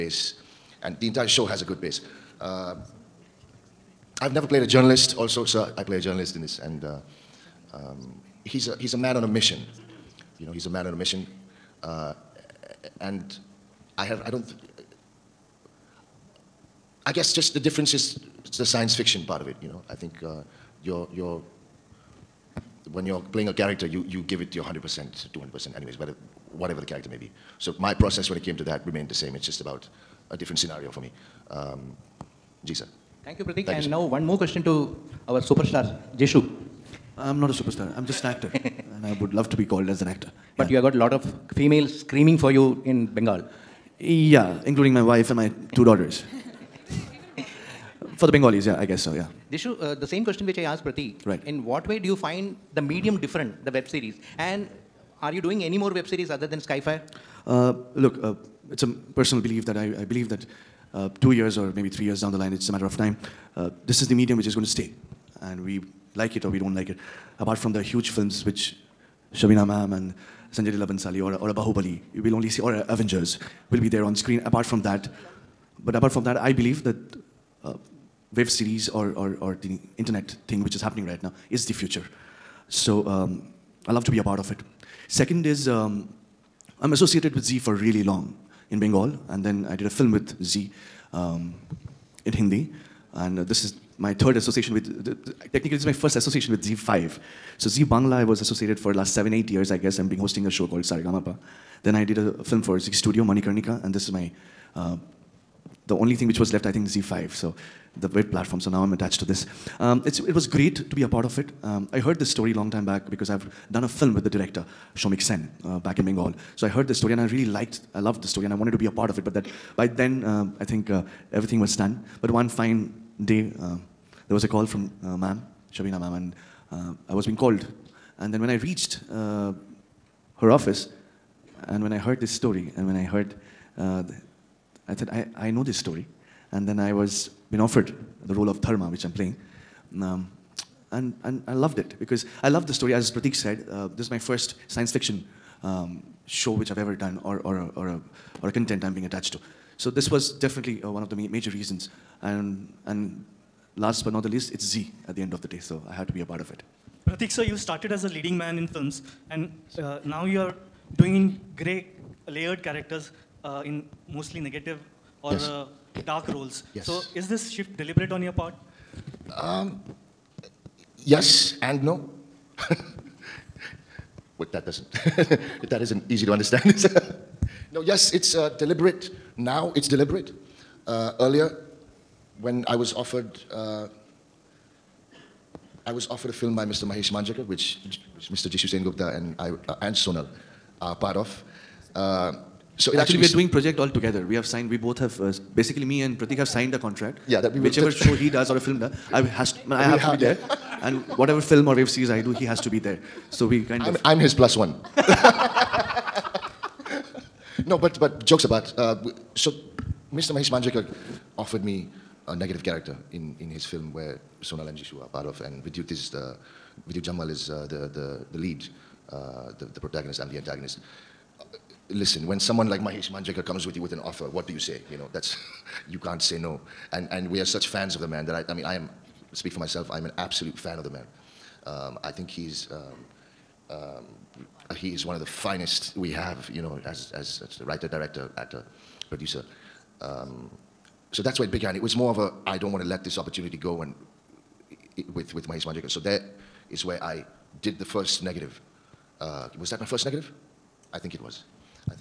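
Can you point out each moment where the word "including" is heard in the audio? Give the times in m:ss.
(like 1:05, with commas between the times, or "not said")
0:44.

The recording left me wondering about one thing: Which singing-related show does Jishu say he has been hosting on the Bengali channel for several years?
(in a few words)
Saregamapa.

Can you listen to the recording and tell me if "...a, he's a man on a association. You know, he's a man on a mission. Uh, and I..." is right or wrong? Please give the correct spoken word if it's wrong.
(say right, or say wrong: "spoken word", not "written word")
wrong: "mission", not "association".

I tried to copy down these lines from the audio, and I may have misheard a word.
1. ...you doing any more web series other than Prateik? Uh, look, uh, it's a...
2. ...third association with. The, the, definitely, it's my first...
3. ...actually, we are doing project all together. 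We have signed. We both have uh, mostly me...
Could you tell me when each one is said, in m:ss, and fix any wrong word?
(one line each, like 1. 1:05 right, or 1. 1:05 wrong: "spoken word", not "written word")
1. 0:55 wrong: "Skyfire", not "Prateik"
2. 1:34 wrong: "technically", not "definitely"
3. 3:13 wrong: "basically", not "mostly".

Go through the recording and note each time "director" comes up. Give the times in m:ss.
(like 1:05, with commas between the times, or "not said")
1:54, 3:57.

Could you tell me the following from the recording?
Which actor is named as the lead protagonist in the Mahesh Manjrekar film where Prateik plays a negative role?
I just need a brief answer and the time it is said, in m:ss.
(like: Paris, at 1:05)
Vidyut Jammwal, at 3:36.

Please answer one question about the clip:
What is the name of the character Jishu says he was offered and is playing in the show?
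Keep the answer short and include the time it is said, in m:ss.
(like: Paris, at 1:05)
Dharma, at 2:18.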